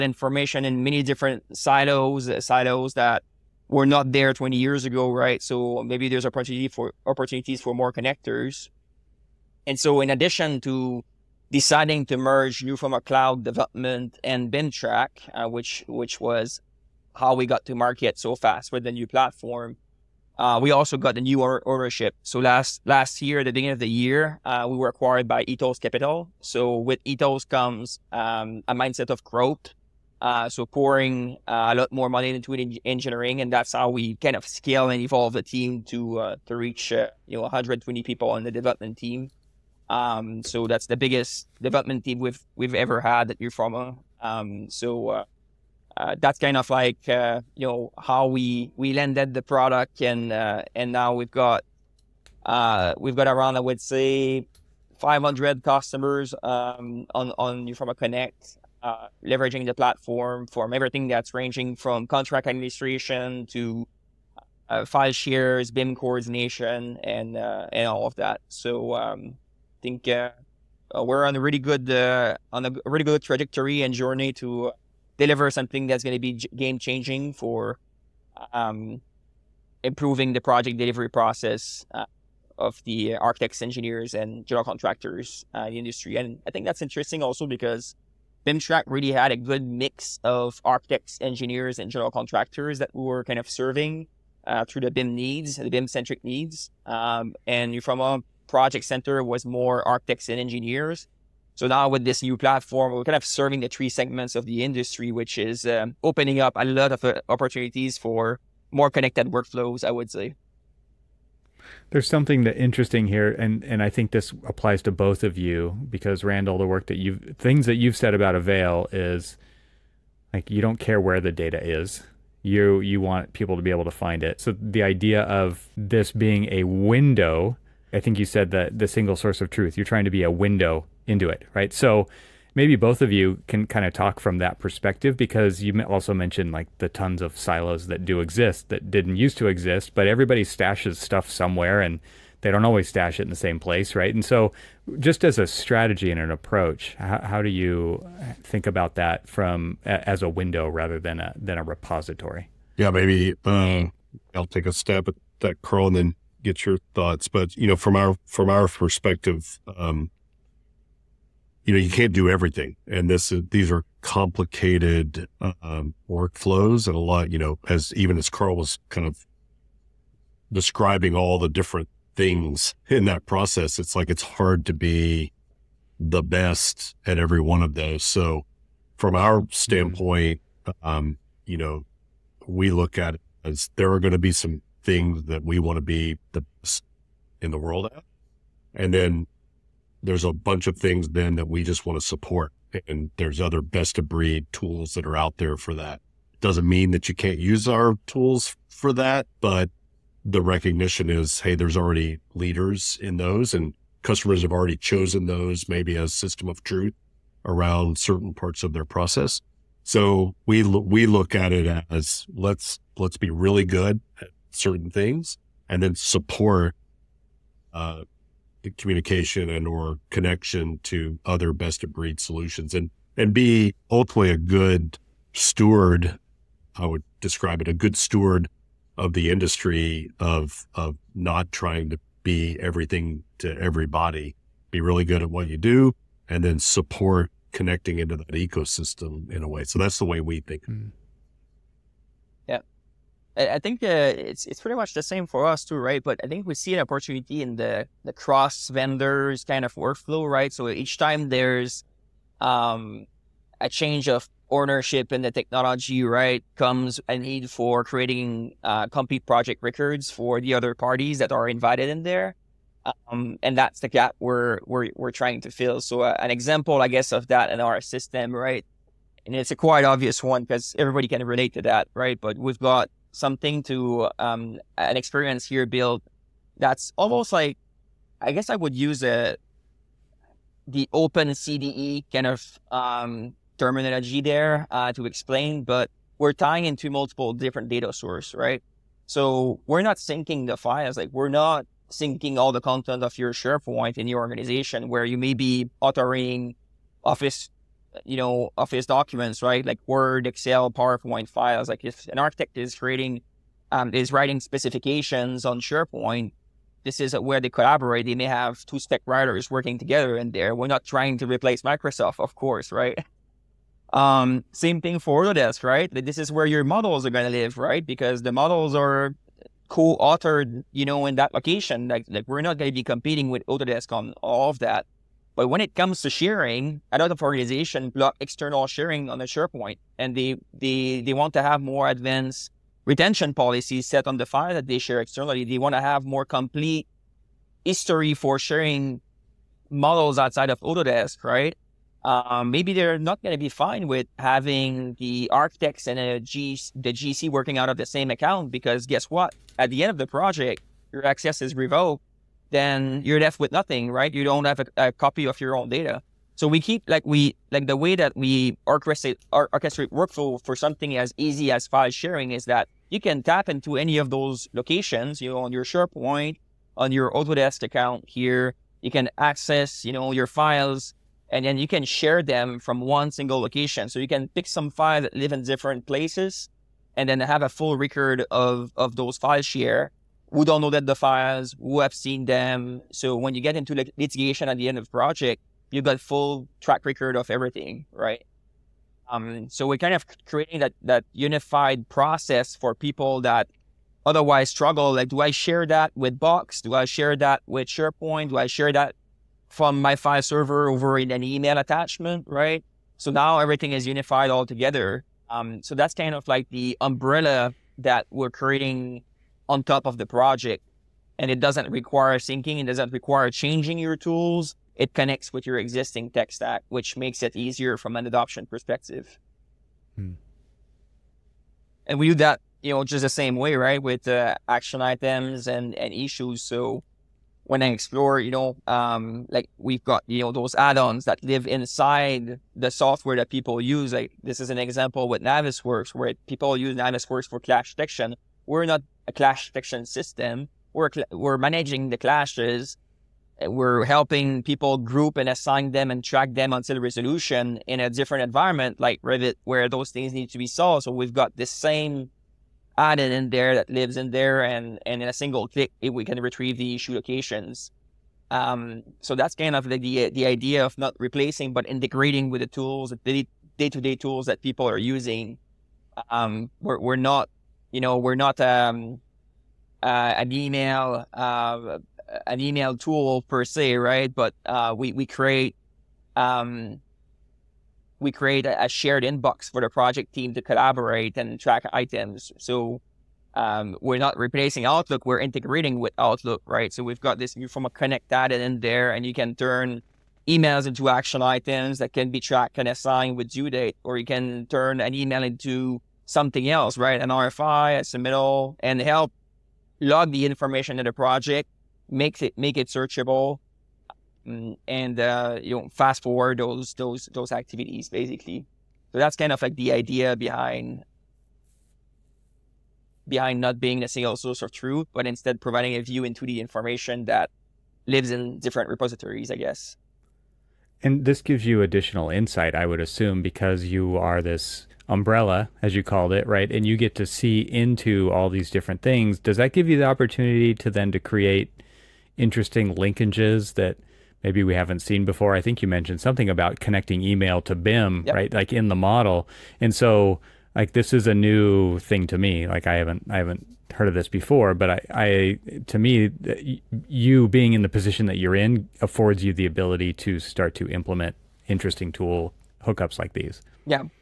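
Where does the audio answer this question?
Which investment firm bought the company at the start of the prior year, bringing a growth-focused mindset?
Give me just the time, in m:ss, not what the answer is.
0:25.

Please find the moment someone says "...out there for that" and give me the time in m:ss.
3:15.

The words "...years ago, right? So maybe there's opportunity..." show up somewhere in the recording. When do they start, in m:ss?
0:04.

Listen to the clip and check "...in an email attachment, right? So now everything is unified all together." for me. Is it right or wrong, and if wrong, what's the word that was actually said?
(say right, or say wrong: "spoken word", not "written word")
right.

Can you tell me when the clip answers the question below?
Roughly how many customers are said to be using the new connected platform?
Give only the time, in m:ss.
0:54.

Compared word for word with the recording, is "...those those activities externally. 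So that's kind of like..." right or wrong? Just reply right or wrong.
wrong.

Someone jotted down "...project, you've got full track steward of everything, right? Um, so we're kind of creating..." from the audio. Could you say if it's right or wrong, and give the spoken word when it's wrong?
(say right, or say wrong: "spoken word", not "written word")
wrong: "record", not "steward".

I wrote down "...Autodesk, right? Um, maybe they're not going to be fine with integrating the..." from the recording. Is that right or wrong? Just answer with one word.
wrong.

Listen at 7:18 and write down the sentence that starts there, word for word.
We're not a clash detection system.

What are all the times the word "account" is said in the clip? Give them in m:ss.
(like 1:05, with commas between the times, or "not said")
5:48, 6:07.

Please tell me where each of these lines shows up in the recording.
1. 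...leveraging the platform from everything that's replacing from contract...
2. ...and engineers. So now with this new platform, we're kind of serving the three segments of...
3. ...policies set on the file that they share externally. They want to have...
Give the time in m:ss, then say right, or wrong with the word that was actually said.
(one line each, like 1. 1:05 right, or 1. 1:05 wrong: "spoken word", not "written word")
1. 0:59 wrong: "ranging", not "replacing"
2. 1:40 right
3. 5:33 right.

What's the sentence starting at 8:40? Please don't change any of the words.
And this gives you additional insight, I would assume, because you are this umbrella, as you called it, right?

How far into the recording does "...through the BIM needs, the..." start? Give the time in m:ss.
1:34.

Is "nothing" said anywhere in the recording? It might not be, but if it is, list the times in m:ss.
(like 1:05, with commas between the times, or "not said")
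5:53.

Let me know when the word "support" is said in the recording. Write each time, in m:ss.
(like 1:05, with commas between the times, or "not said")
3:12, 3:35, 3:56.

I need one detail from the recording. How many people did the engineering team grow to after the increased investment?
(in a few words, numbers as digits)
120.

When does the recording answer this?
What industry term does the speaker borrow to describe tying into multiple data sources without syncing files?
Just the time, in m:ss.
4:40.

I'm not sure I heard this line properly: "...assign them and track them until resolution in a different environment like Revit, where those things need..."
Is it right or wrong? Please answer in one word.
right.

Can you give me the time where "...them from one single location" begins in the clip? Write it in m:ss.
6:12.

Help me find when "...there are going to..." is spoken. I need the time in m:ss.
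3:03.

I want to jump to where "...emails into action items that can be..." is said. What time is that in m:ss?
8:10.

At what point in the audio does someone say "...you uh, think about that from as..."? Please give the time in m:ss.
2:27.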